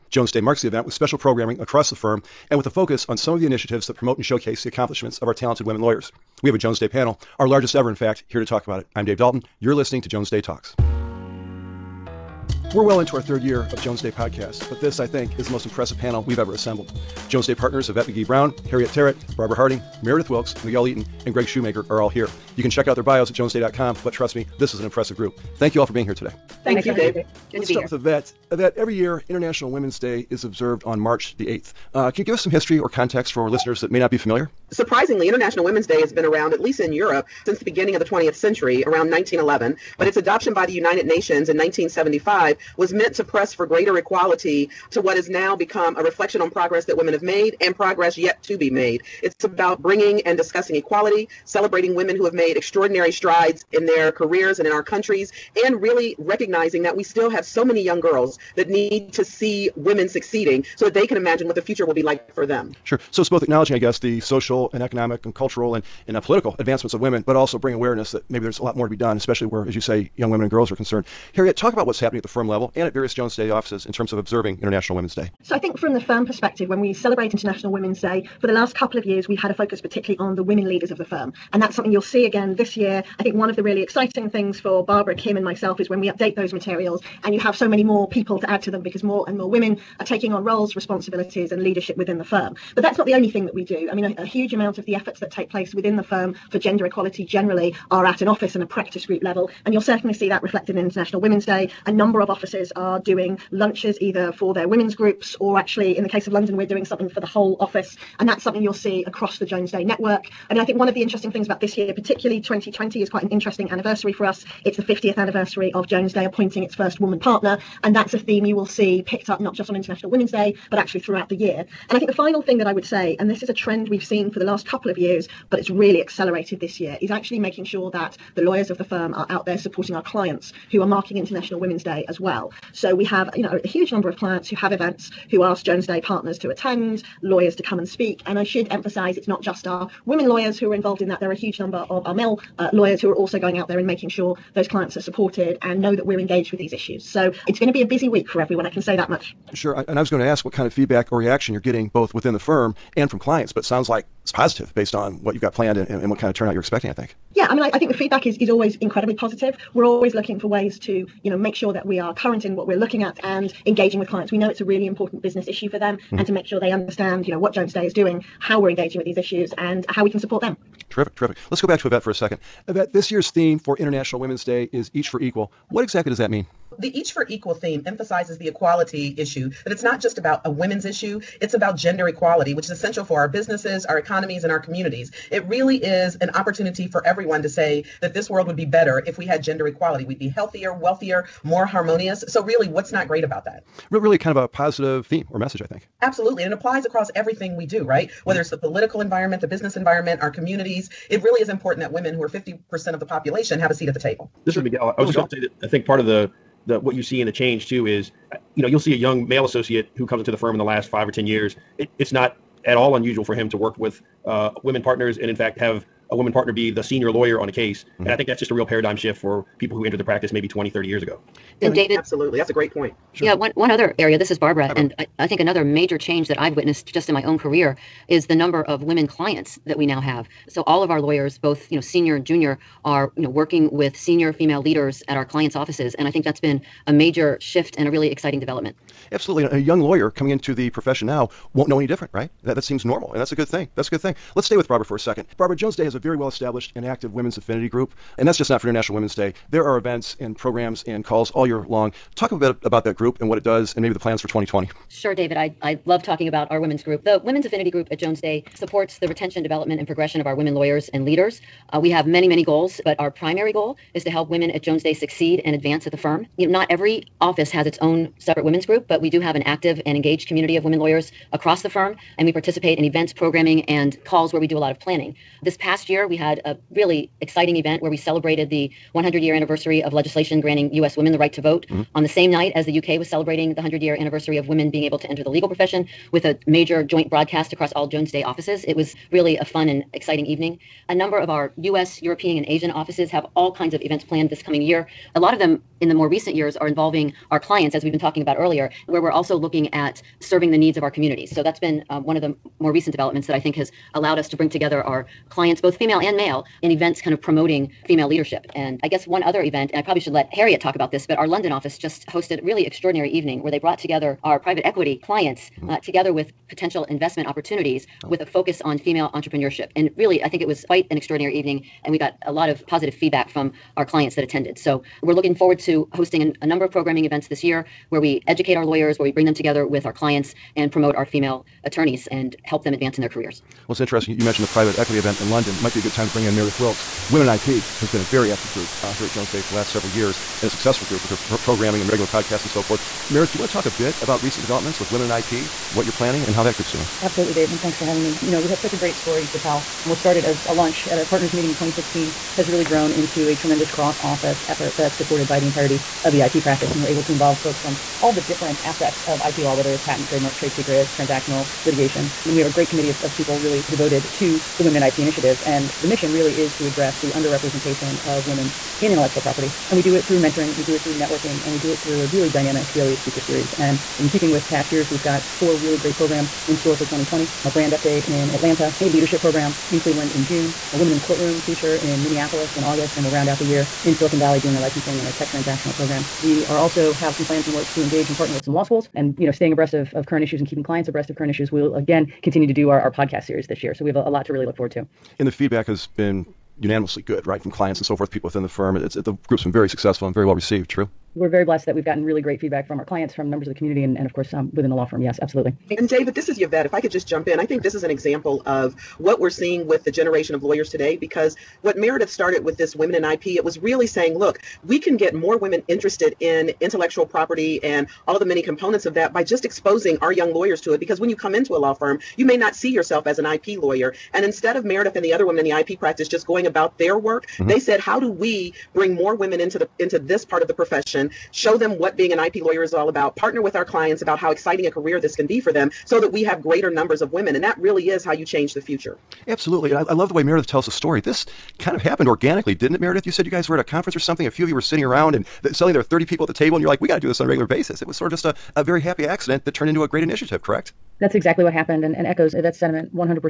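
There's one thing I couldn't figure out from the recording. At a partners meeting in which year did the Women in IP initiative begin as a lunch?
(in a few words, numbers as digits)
2016.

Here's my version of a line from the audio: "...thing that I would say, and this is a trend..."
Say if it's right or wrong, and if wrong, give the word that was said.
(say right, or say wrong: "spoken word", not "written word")
right.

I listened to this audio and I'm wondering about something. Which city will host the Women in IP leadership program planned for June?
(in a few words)
Cleveland.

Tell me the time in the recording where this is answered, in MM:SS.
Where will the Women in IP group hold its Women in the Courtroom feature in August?
06:22.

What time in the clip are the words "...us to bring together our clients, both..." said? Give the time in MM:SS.
05:04.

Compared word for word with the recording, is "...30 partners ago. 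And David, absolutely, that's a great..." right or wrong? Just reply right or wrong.
wrong.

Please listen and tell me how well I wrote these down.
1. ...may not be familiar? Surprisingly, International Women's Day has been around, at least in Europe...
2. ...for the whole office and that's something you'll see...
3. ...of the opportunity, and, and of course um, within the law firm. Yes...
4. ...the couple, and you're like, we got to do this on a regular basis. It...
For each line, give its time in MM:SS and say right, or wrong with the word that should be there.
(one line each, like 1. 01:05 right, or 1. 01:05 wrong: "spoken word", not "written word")
1. 00:33 right
2. 01:47 right
3. 06:43 wrong: "community", not "opportunity"
4. 07:26 wrong: "table", not "couple".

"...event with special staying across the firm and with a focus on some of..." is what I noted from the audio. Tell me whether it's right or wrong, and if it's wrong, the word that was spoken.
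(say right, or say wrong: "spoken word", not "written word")
wrong: "programming", not "staying".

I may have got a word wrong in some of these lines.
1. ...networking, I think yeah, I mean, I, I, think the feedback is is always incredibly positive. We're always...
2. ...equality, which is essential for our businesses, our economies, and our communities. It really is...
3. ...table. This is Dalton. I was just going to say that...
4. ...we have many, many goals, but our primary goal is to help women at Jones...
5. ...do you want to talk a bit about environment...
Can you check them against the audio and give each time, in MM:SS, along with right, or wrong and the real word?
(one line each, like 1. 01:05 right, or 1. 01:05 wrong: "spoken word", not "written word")
1. 02:36 wrong: "expecting", not "networking"
2. 03:02 right
3. 03:23 wrong: "Miguel", not "Dalton"
4. 04:21 right
5. 05:43 wrong: "recent", not "environment".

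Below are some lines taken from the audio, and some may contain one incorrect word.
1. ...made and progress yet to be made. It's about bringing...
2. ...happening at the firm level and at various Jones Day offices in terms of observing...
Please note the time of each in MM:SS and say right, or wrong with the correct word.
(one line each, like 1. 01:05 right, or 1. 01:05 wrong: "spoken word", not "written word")
1. 00:47 right
2. 01:11 right.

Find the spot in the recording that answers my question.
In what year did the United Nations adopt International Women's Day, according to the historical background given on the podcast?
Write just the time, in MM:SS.
00:41.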